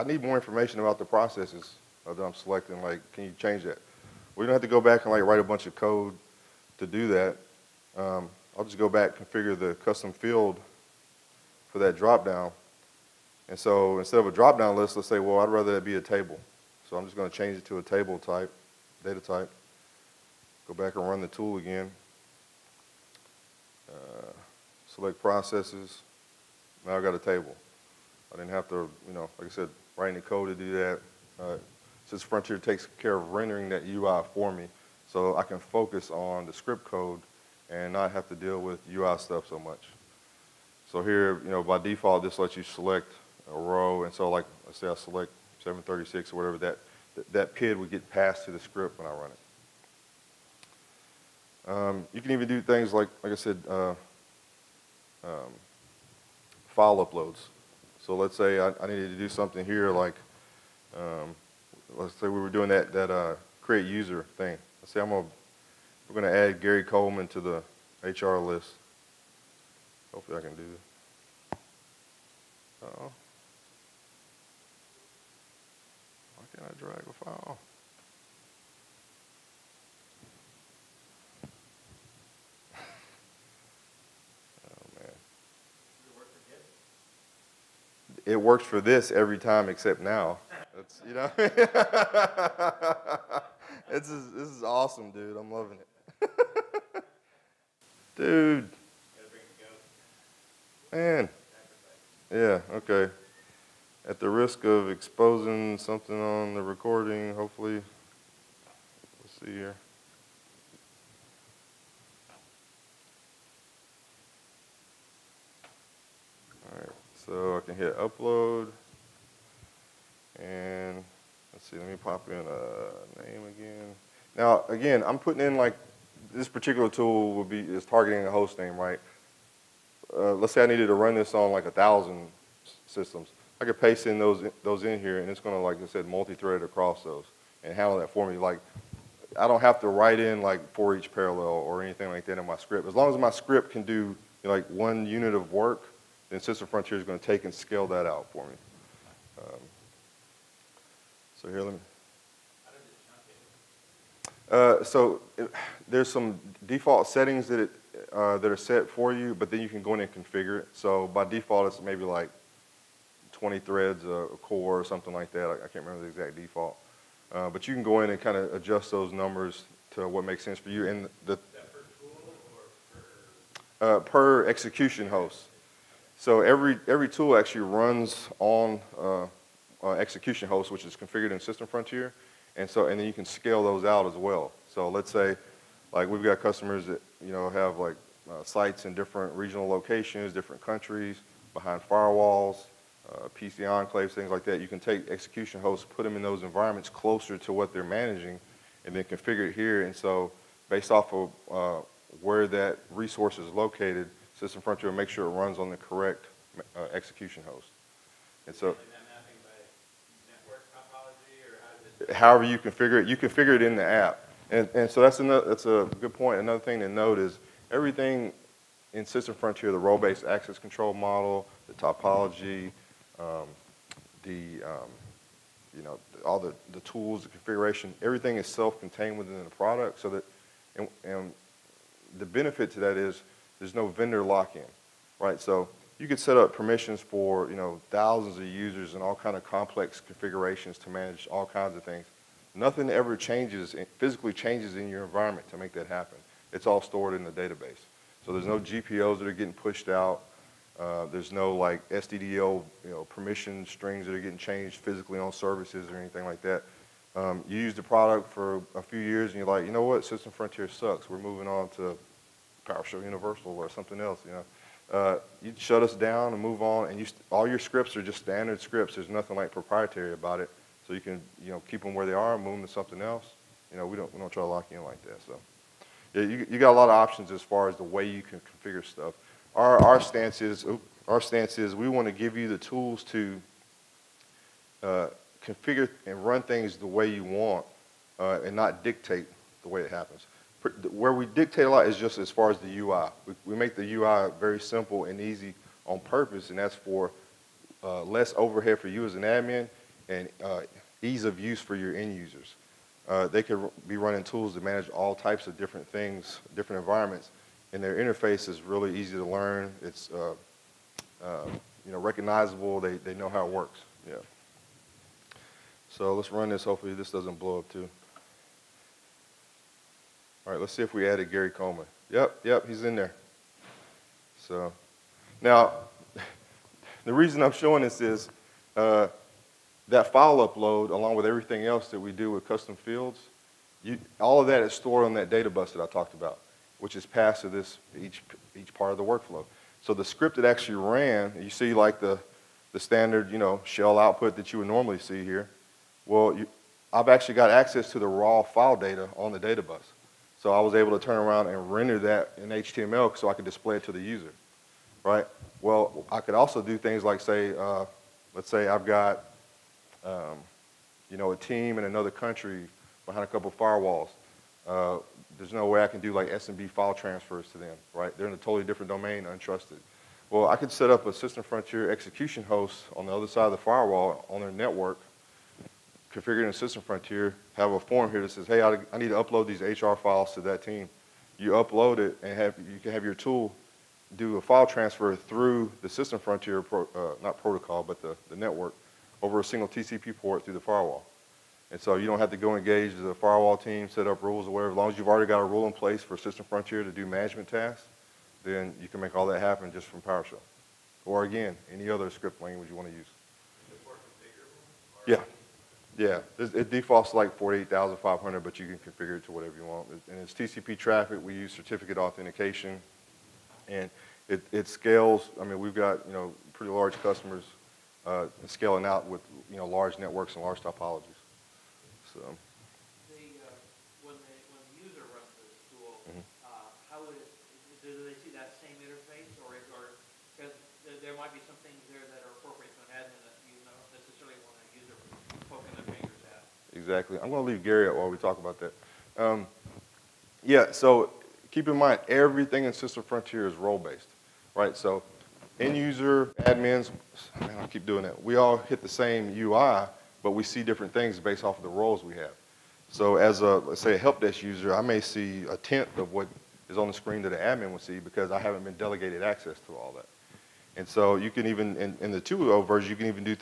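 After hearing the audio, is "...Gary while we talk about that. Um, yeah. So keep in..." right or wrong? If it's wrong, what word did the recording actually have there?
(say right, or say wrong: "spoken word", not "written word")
right.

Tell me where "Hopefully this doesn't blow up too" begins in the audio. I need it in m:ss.
5:16.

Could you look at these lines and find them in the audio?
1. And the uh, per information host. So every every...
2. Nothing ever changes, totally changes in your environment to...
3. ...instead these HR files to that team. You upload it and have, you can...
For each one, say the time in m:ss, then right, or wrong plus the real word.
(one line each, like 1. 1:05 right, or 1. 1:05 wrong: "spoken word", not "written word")
1. 2:50 wrong: "execution", not "information"
2. 4:02 wrong: "physically", not "totally"
3. 6:19 wrong: "upload", not "instead".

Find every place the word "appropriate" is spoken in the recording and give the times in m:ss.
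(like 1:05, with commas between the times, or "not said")
7:12.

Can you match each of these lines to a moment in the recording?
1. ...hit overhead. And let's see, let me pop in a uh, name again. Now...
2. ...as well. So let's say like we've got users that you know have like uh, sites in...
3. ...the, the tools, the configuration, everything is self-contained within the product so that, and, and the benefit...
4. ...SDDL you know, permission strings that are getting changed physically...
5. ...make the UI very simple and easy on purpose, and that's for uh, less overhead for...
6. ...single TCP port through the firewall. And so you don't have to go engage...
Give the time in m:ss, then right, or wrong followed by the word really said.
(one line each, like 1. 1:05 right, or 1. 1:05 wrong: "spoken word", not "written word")
1. 1:57 wrong: "upload", not "overhead"
2. 3:04 wrong: "customers", not "users"
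3. 3:46 right
4. 4:11 right
5. 4:53 right
6. 6:29 right.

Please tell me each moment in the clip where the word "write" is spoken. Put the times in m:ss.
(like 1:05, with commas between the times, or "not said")
0:05, 0:29, 2:19.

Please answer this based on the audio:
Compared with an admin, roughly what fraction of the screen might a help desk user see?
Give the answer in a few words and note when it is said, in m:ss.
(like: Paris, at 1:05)
a tenth, at 7:35.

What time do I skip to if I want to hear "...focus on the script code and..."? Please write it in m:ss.
0:35.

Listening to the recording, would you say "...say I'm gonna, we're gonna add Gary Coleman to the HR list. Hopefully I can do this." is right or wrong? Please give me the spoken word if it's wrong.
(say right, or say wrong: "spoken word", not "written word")
right.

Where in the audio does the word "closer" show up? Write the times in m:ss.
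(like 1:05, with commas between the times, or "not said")
3:16.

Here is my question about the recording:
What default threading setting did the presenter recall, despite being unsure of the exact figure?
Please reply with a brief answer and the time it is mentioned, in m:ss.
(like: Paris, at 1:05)
20 threads a core, at 2:43.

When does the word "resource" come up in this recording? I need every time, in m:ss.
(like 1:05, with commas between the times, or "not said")
3:22.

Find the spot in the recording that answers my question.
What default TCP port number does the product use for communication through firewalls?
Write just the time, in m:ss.
6:47.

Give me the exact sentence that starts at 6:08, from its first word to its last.
They're in a totally different domain, untrusted.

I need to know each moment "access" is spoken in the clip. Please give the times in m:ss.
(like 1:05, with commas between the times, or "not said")
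3:40, 5:47, 7:39.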